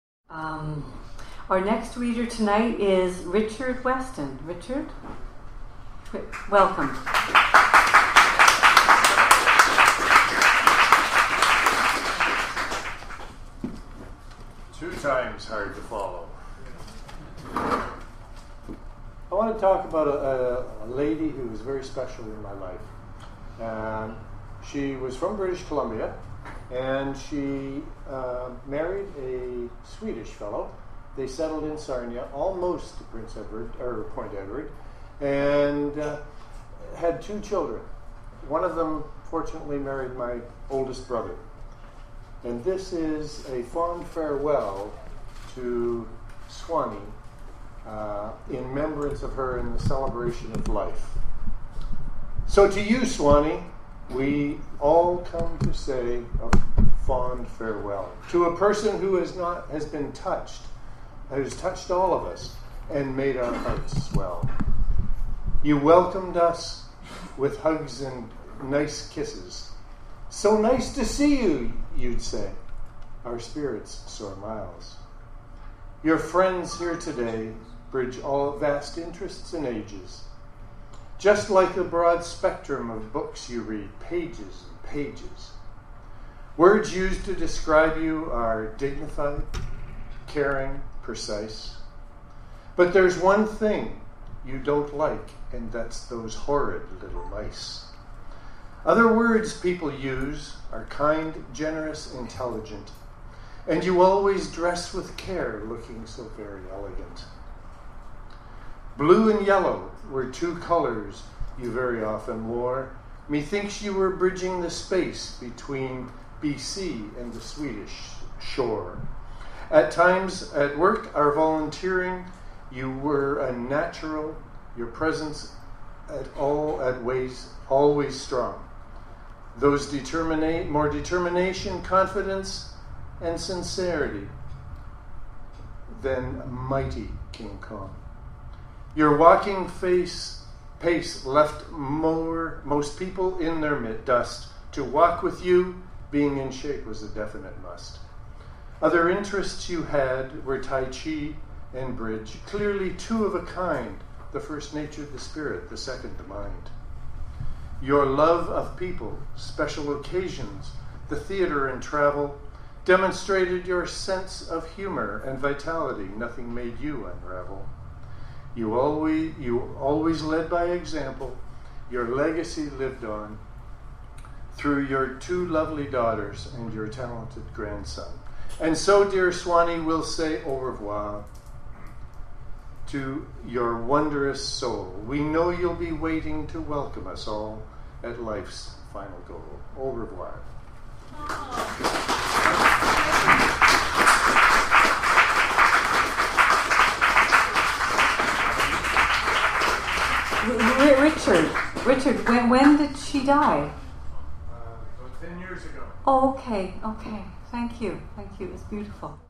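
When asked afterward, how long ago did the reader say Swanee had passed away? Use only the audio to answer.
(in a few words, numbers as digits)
About 10 years ago.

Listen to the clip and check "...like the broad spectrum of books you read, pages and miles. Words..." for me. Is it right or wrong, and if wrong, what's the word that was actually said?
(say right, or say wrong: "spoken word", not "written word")
wrong: "pages", not "miles".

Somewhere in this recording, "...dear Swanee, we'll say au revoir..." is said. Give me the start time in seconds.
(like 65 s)
179 s.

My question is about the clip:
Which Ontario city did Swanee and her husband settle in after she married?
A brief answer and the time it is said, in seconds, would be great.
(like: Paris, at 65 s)
Sarnia, at 31 s.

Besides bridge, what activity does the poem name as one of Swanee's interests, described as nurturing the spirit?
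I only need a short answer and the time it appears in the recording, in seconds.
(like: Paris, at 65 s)
Tai Chi, at 150 s.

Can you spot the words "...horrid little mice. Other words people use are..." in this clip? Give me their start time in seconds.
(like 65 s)
96 s.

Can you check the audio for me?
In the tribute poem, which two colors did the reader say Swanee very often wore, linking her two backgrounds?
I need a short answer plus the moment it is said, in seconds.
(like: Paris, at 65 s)
Blue and yellow, at 108 s.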